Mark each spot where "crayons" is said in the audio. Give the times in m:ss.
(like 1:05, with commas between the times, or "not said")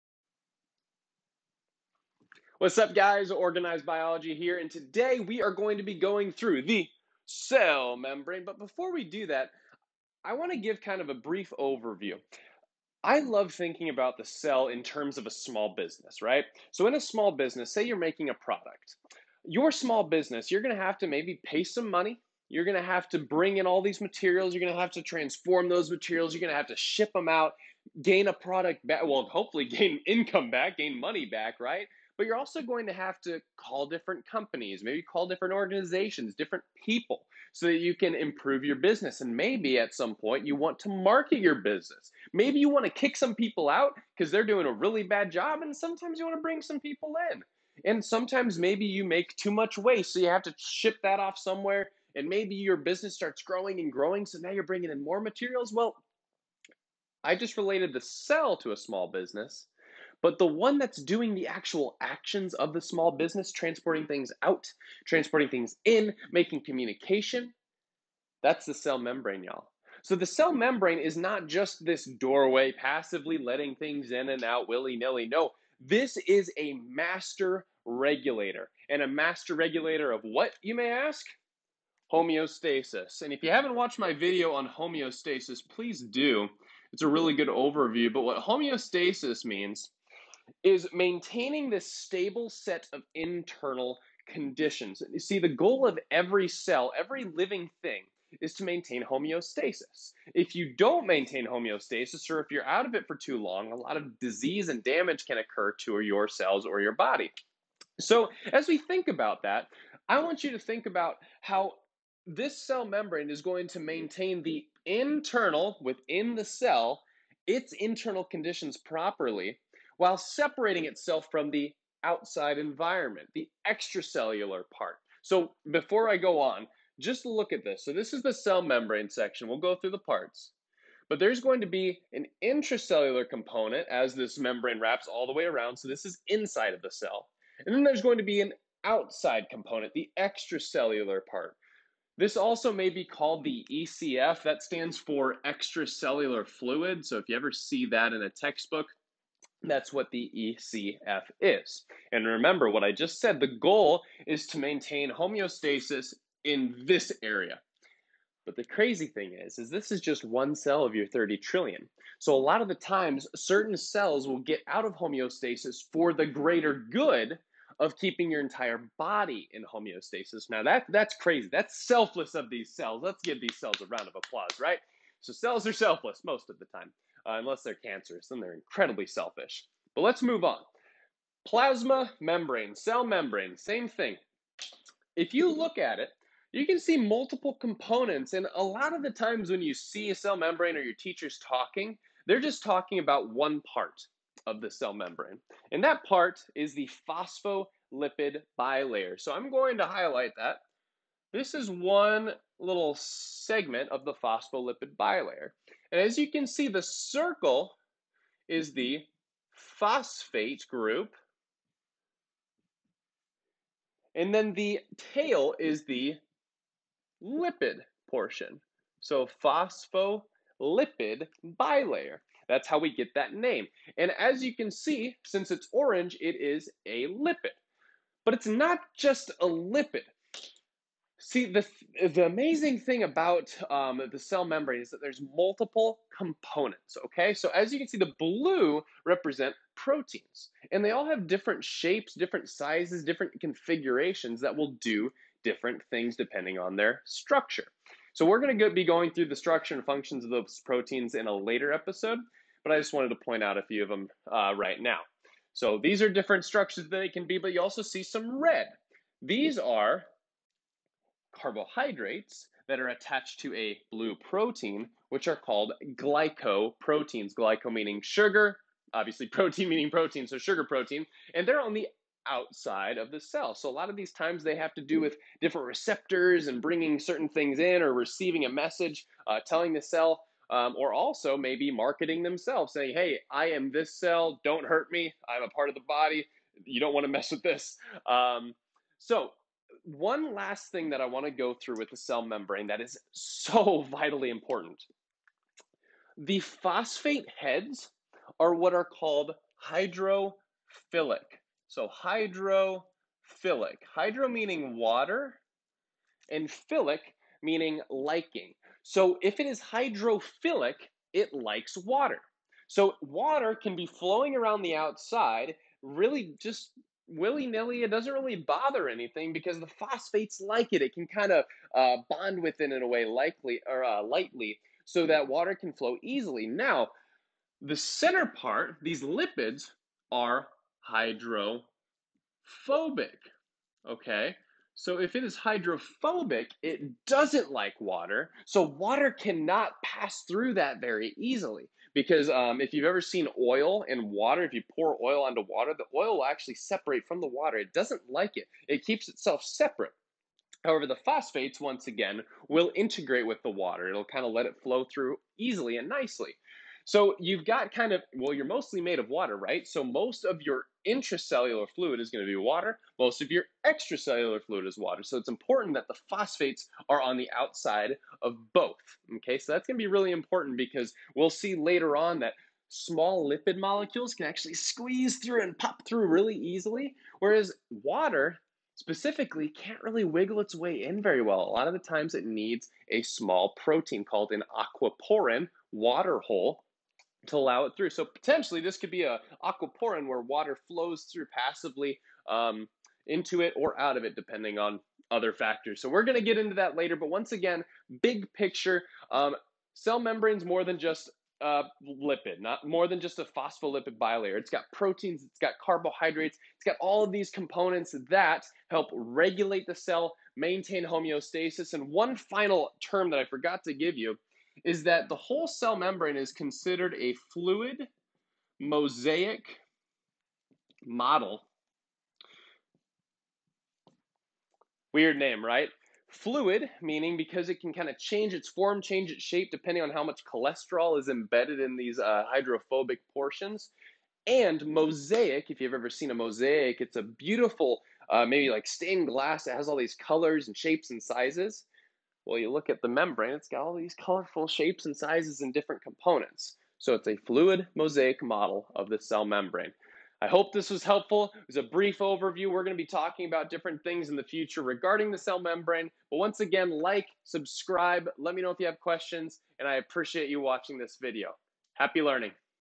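not said.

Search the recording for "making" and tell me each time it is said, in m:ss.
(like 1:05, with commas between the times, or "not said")
0:17, 1:06.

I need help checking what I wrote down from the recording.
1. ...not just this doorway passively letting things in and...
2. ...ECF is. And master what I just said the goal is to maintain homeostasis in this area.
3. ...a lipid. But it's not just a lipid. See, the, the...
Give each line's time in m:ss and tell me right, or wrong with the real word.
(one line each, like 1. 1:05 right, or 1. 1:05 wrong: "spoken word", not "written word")
1. 1:11 right
2. 2:30 wrong: "remember", not "master"
3. 3:46 right.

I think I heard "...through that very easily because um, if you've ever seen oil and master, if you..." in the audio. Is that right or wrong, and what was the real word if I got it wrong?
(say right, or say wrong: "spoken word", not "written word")
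wrong: "water", not "master".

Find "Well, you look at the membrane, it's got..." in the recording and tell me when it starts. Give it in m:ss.
7:22.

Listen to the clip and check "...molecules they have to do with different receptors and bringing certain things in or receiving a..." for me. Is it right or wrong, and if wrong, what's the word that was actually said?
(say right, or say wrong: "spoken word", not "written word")
wrong: "times", not "molecules".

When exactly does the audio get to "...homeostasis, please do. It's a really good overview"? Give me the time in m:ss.
1:24.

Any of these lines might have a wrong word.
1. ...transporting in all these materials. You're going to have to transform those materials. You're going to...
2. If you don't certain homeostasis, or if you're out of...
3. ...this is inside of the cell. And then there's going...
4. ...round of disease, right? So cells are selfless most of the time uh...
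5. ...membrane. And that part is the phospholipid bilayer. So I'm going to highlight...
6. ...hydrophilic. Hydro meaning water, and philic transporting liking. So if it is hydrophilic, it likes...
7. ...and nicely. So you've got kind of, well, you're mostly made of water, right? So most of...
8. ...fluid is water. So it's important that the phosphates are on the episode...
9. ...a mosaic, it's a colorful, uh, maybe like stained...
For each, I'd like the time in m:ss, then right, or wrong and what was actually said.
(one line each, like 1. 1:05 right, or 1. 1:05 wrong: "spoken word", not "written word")
1. 0:23 wrong: "bring", not "transporting"
2. 1:40 wrong: "maintain", not "certain"
3. 2:15 right
4. 2:53 wrong: "applause", not "disease"
5. 3:14 right
6. 5:02 wrong: "meaning", not "transporting"
7. 5:55 right
8. 6:04 wrong: "outside", not "episode"
9. 7:16 wrong: "beautiful", not "colorful".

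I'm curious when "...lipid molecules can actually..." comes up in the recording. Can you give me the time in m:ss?
6:13.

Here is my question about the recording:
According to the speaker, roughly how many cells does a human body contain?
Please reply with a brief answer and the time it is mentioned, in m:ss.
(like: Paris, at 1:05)
30 trillion, at 2:41.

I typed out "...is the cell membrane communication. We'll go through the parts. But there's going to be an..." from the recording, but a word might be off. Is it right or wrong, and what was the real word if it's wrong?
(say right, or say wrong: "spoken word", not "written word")
wrong: "section", not "communication".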